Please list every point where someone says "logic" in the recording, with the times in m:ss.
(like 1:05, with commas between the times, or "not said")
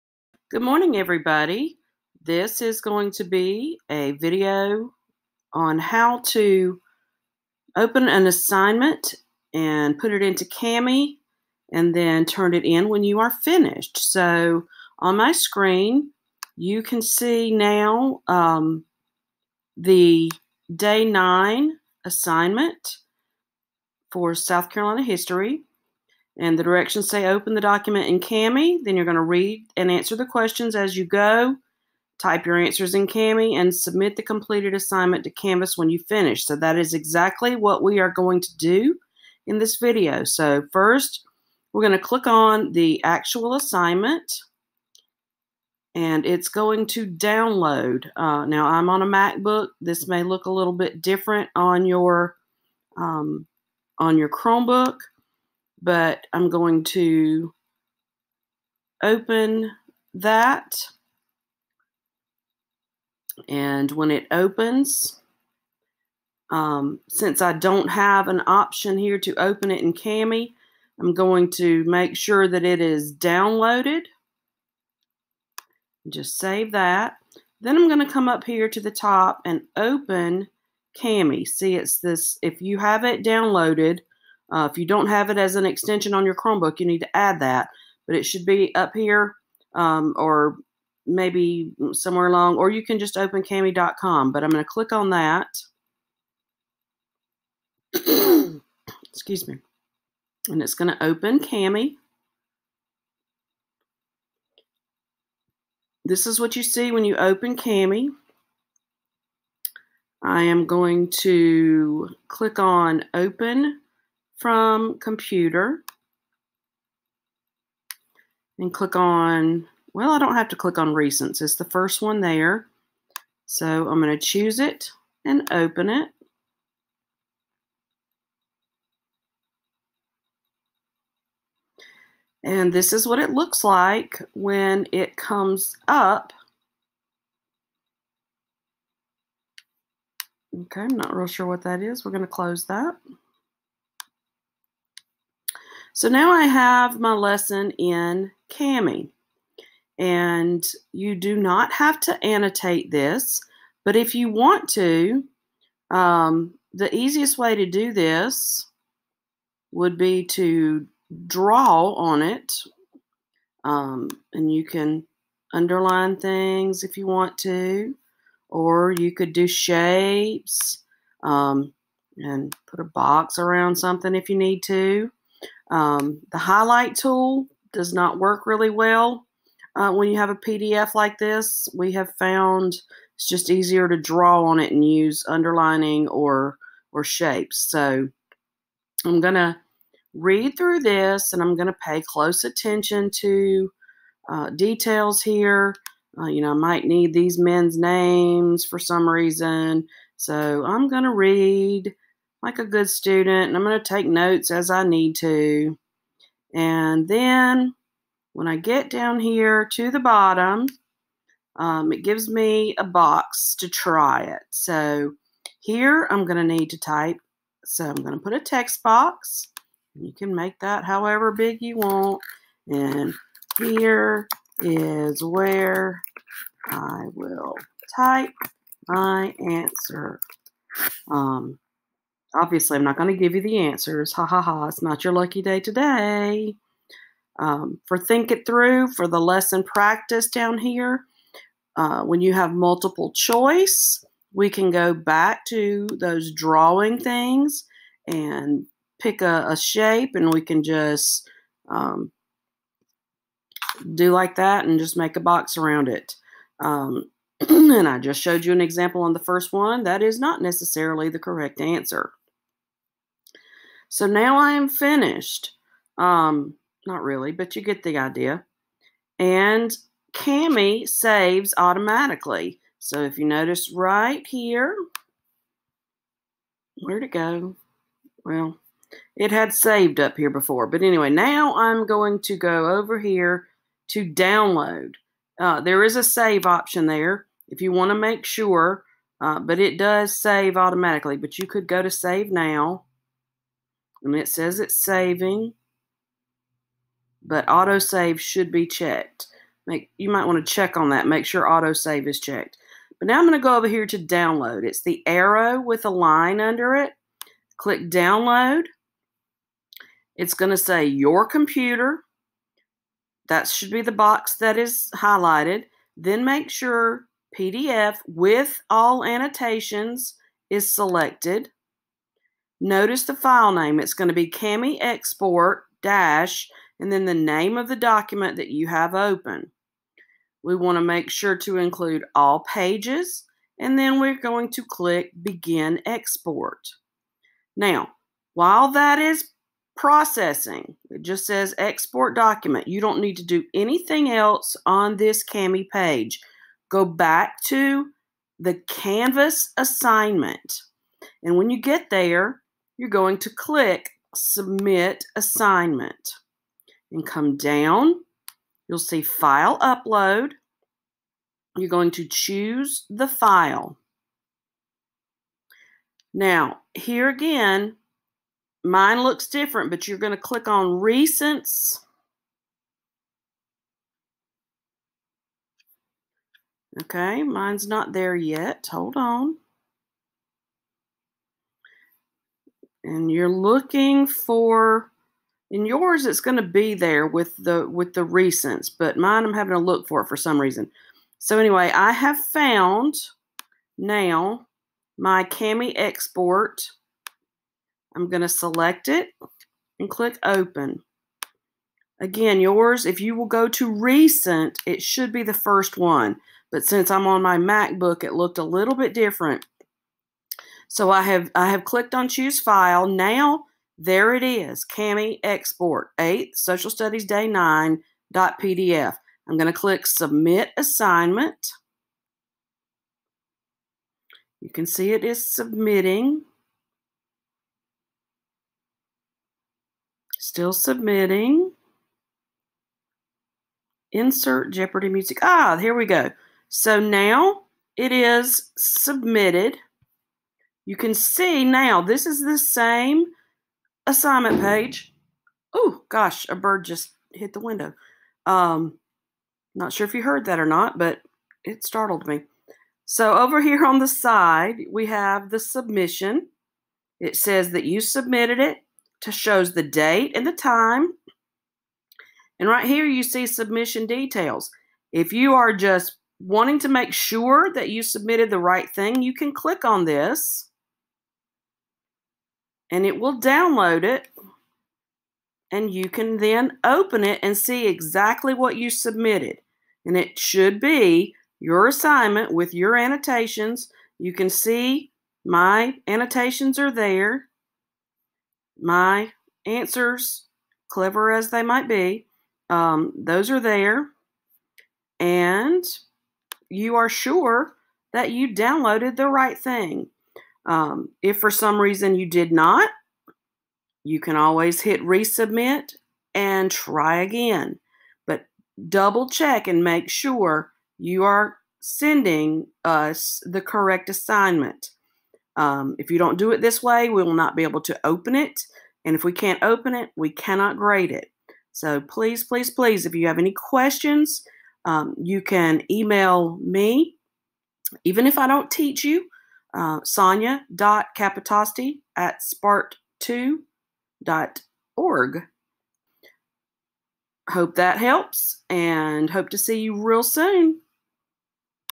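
not said.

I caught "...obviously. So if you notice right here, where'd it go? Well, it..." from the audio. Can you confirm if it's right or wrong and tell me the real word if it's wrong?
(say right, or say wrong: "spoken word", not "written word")
wrong: "automatically", not "obviously".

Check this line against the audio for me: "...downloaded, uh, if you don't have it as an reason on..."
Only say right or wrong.
wrong.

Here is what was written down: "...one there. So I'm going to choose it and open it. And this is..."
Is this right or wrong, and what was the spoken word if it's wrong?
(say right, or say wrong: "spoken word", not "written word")
right.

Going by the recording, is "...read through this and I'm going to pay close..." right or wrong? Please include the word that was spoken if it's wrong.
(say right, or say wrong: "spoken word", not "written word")
right.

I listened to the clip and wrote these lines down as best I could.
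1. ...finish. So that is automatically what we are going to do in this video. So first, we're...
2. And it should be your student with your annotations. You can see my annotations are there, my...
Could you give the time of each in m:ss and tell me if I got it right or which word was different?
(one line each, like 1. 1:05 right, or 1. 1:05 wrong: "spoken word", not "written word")
1. 0:36 wrong: "exactly", not "automatically"
2. 7:59 wrong: "assignment", not "student".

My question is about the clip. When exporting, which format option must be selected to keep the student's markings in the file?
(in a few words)
PDF with all annotations.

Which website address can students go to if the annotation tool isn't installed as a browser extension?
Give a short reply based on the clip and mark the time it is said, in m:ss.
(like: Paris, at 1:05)
kami.com, at 1:33.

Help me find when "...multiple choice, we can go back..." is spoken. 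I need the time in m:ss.
4:02.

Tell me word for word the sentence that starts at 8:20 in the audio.
Um, if for some reason you did not, you can always hit resubmit and try again.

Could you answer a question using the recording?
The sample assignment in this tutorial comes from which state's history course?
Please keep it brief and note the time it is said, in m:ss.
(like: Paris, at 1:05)
South Carolina, at 0:24.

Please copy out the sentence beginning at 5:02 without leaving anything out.
But now I'm going to go over here to download.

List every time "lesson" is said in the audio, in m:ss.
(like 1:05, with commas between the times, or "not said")
2:27, 3:59.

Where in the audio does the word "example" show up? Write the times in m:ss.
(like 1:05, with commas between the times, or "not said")
4:18.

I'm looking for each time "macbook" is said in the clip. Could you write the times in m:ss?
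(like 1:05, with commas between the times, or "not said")
0:49, 6:47.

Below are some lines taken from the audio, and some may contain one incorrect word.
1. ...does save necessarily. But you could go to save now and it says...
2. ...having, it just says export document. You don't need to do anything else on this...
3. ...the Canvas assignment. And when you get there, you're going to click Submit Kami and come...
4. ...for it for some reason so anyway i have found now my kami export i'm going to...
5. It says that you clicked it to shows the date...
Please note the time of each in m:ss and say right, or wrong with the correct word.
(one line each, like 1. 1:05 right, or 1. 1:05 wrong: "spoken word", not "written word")
1. 4:49 wrong: "automatically", not "necessarily"
2. 5:39 wrong: "processing", not "having"
3. 5:48 wrong: "Assignment", not "Kami"
4. 6:29 right
5. 7:36 wrong: "submitted", not "clicked".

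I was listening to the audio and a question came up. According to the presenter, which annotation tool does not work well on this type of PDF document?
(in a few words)
highlight tool.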